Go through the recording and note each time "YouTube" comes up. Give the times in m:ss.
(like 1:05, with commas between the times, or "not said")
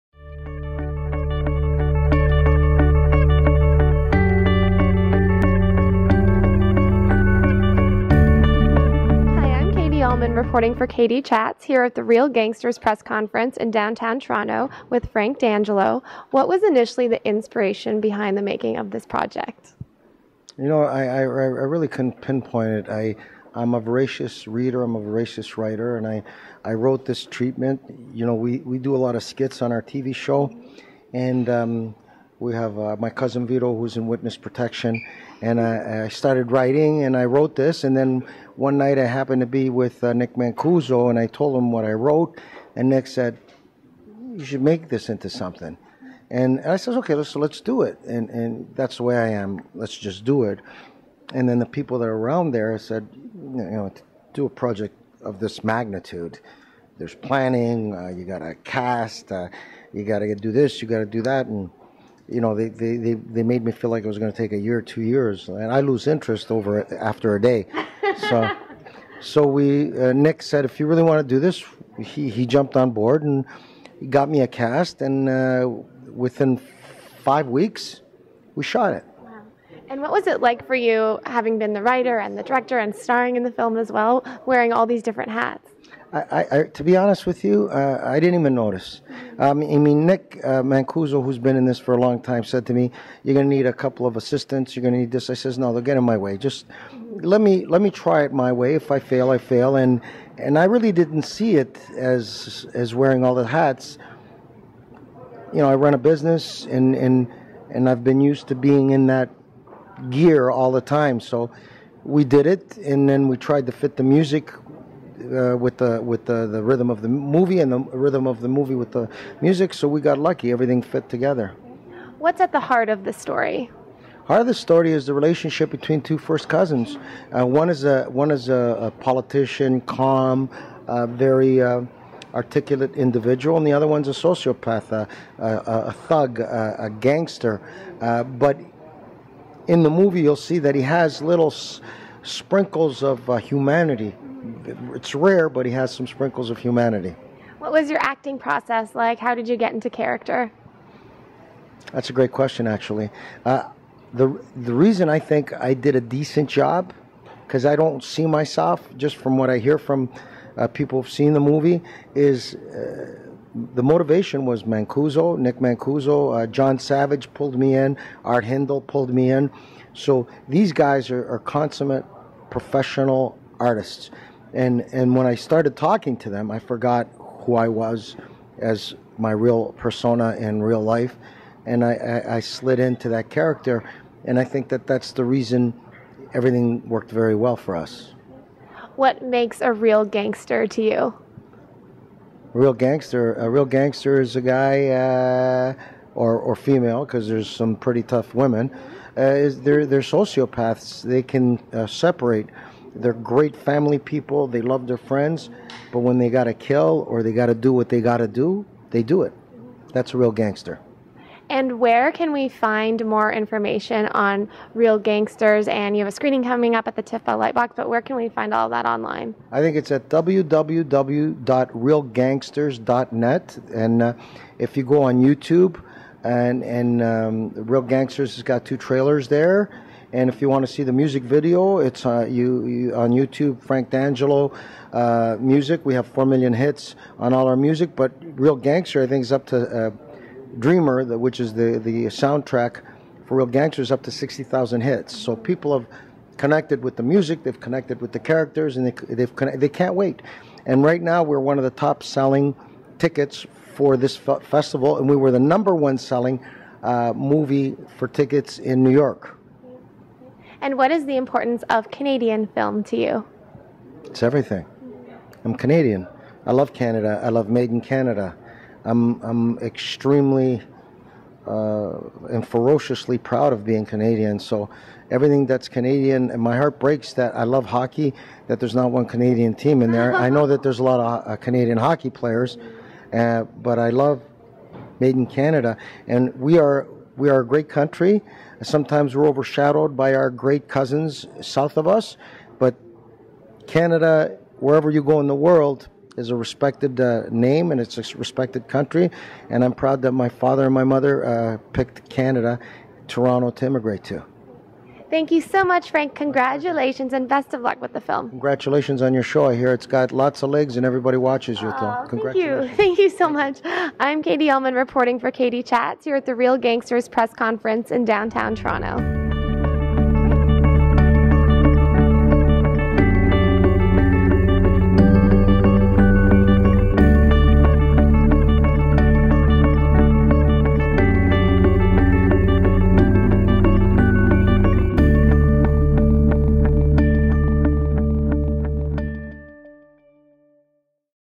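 3:45, 3:53.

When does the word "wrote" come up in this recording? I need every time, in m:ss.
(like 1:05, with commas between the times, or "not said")
0:26, 0:37, 0:41.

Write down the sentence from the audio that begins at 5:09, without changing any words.
I hear it's got lots of legs and everybody watches your oh, Thank you.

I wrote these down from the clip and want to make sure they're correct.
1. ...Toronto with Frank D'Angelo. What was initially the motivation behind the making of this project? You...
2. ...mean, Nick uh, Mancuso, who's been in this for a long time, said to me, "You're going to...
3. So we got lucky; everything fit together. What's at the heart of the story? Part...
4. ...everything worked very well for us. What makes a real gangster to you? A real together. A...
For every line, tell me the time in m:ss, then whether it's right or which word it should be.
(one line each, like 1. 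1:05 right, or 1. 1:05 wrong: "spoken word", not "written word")
1. 0:14 wrong: "inspiration", not "motivation"
2. 1:29 right
3. 1:59 right
4. 3:06 wrong: "gangster", not "together".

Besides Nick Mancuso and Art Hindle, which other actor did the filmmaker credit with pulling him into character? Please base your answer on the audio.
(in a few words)
John Savage.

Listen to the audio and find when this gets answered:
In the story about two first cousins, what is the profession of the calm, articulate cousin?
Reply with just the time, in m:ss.
2:08.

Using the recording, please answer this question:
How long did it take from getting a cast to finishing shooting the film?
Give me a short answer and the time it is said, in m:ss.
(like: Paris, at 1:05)
5 weeks, at 1:17.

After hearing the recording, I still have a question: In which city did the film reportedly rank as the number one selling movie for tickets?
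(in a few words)
New York.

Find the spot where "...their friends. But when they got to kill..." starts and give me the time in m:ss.
3:24.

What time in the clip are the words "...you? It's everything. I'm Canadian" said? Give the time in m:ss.
4:22.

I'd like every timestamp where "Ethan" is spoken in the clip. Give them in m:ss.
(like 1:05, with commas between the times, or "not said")
not said.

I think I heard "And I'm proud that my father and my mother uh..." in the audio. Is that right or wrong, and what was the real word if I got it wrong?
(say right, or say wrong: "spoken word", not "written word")
right.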